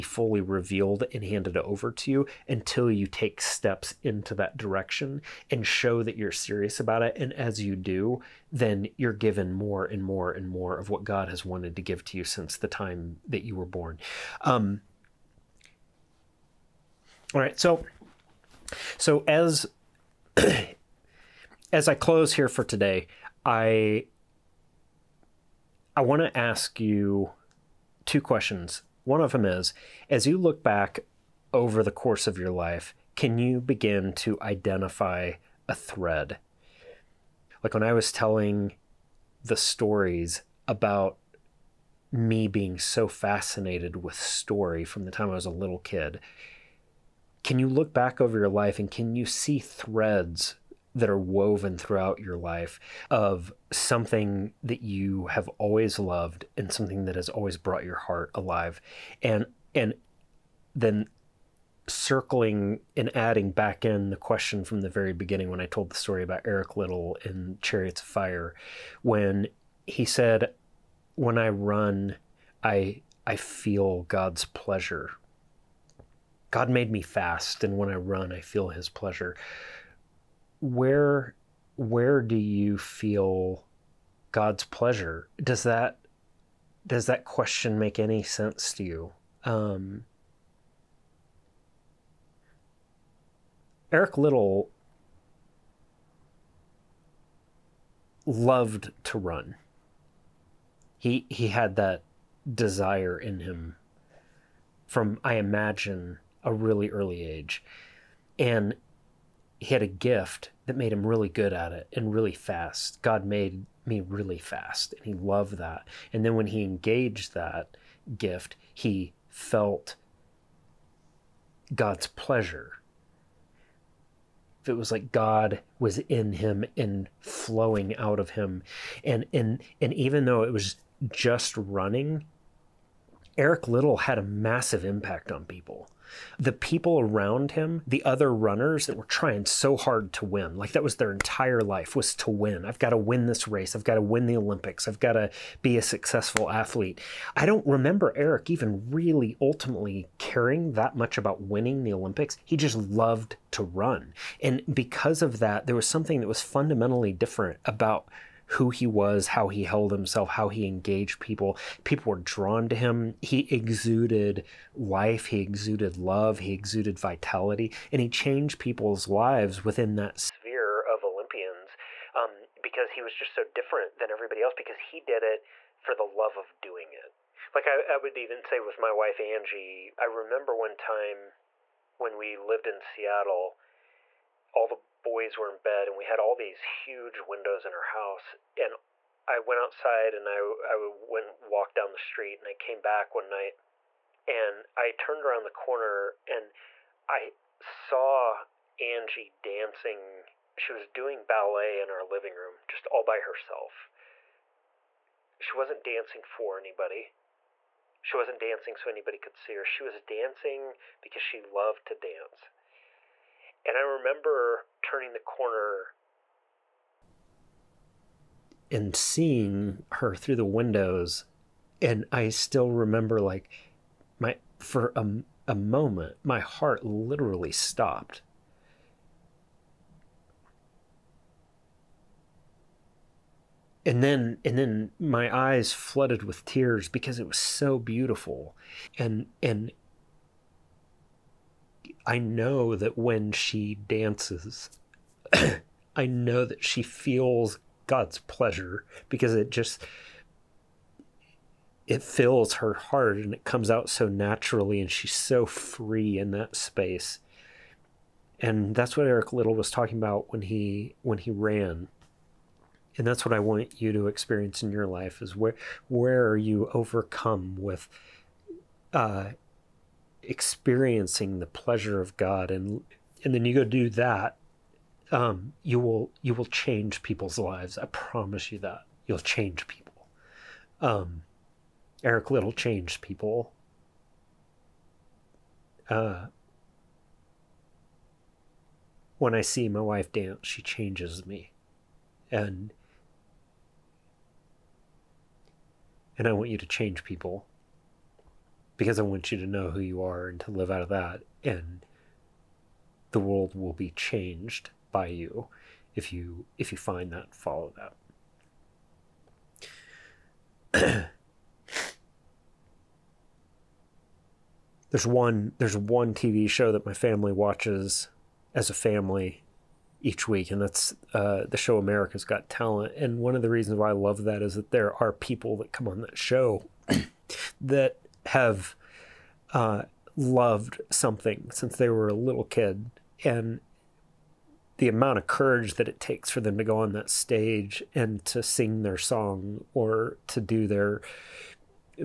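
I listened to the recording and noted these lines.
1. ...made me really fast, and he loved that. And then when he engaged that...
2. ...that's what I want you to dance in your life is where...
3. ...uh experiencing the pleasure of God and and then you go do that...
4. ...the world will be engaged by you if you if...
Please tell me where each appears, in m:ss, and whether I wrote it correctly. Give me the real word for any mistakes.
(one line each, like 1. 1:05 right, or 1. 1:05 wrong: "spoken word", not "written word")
1. 1:53 right
2. 4:23 wrong: "experience", not "dance"
3. 4:28 right
4. 5:03 wrong: "changed", not "engaged".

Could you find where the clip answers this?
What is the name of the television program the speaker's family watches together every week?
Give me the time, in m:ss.
5:21.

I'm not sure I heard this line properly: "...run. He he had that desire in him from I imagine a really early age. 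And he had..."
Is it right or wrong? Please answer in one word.
right.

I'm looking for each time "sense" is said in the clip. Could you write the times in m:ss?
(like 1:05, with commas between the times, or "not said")
1:28.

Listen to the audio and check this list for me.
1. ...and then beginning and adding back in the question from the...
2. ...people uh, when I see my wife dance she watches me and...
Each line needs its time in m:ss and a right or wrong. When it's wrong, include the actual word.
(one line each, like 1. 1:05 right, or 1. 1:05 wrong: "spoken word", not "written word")
1. 0:59 wrong: "circling", not "beginning"
2. 4:43 wrong: "changes", not "watches".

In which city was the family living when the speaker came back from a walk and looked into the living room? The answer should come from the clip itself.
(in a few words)
Seattle.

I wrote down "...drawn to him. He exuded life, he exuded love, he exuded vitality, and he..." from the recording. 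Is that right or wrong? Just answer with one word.
right.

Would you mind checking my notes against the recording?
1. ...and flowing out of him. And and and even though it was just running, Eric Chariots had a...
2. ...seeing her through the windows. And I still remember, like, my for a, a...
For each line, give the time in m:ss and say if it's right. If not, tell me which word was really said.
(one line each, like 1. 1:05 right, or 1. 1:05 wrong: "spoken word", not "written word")
1. 2:06 wrong: "Liddell", not "Chariots"
2. 3:38 right.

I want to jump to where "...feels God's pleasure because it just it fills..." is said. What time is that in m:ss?
4:06.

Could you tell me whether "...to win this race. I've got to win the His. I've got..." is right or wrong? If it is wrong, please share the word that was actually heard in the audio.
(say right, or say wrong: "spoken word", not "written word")
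wrong: "Olympics", not "His".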